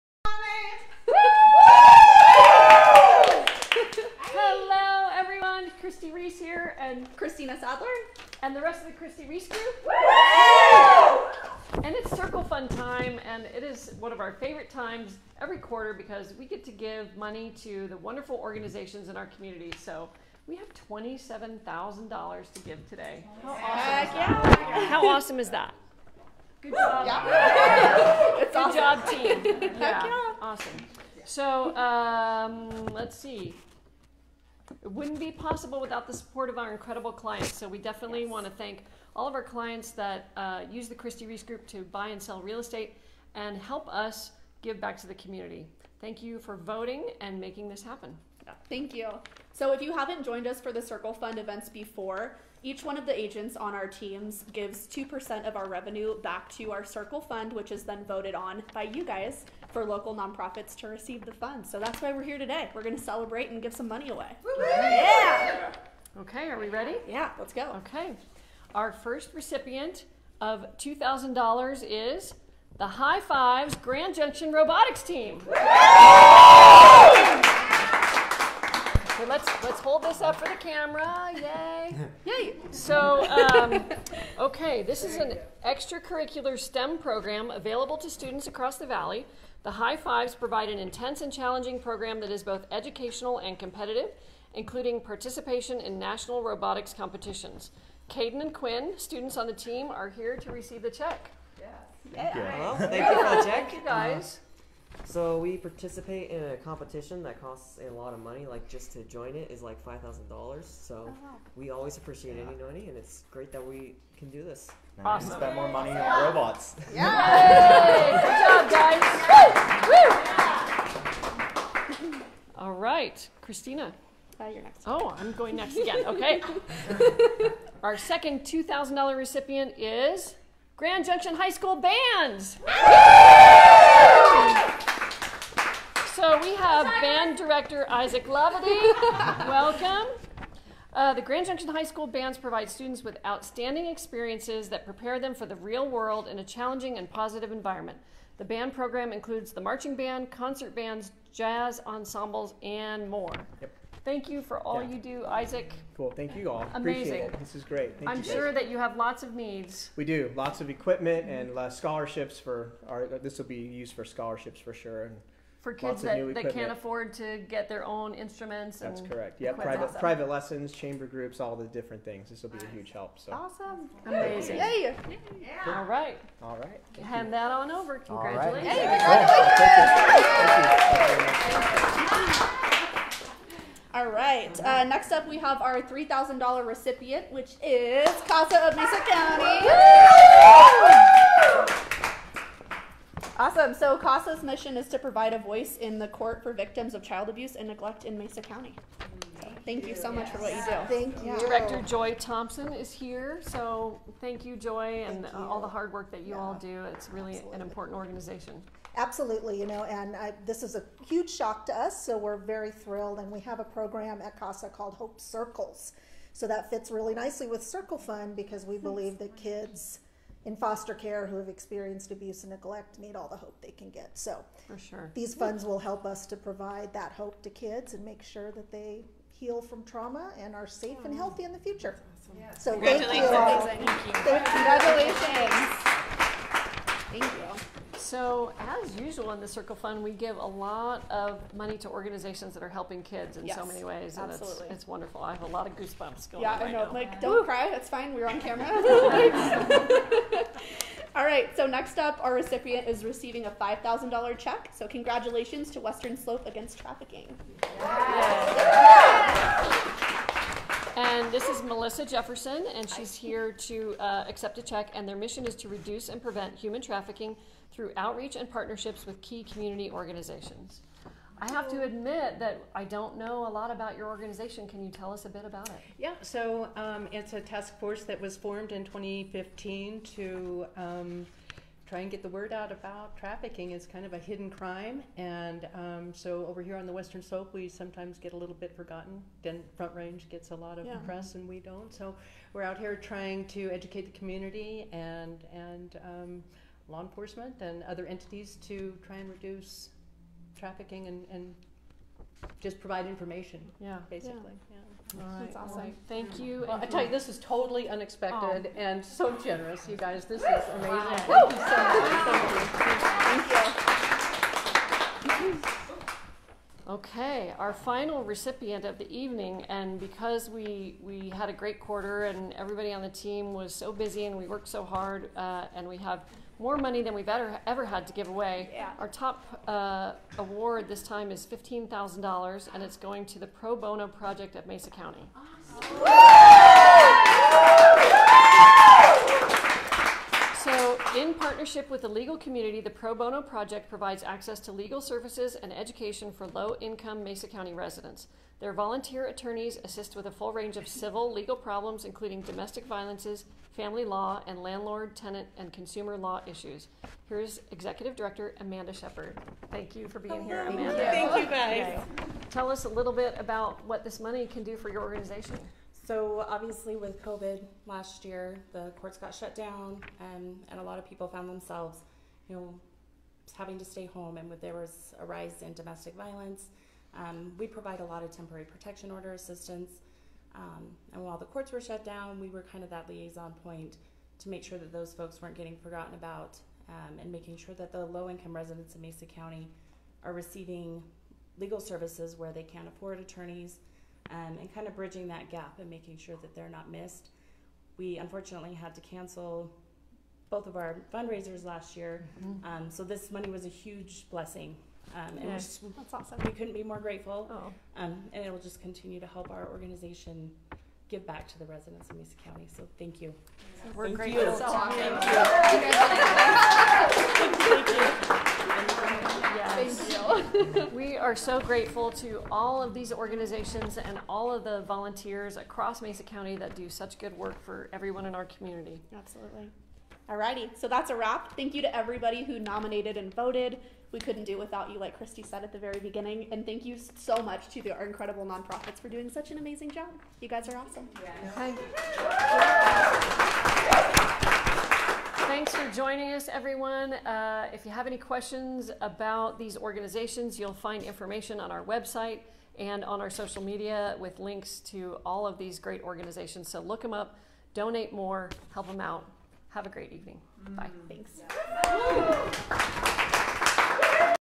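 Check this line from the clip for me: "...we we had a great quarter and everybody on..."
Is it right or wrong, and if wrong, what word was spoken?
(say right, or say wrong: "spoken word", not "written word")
right.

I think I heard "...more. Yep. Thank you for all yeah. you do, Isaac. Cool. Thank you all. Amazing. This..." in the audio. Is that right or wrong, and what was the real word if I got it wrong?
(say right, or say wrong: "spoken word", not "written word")
right.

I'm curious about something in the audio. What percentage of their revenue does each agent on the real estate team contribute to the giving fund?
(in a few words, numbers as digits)
2%.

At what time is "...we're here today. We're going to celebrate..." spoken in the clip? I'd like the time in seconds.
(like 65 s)
62 s.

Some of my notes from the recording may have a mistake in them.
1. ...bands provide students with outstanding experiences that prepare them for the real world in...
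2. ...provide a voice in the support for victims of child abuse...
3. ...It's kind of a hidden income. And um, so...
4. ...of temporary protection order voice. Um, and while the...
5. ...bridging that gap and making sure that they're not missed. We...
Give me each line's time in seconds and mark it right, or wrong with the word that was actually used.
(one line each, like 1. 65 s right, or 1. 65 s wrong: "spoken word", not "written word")
1. 142 s right
2. 194 s wrong: "court", not "support"
3. 283 s wrong: "crime", not "income"
4. 378 s wrong: "assistance", not "voice"
5. 394 s right.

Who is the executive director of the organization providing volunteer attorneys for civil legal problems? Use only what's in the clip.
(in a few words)
Amanda Shepard.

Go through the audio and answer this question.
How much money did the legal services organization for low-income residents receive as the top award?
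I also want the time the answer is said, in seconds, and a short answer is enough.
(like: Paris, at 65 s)
$15,000, at 331 s.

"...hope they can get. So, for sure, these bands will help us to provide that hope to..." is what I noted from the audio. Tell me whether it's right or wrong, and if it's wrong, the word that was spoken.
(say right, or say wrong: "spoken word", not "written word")
wrong: "funds", not "bands".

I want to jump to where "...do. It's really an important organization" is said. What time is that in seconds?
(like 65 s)
206 s.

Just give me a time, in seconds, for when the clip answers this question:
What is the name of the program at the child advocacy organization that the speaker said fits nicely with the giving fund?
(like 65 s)
214 s.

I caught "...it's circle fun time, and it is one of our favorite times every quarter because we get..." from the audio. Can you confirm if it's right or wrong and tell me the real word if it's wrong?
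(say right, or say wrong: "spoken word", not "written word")
right.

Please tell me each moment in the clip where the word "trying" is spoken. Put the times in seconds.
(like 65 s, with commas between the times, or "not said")
292 s.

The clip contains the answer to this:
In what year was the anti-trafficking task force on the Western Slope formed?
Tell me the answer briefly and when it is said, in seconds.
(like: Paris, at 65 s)
2015, at 278 s.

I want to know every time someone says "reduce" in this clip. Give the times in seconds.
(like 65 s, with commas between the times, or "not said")
265 s, 299 s.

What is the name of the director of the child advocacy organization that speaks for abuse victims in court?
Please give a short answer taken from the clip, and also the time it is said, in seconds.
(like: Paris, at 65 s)
Joy Thompson, at 201 s.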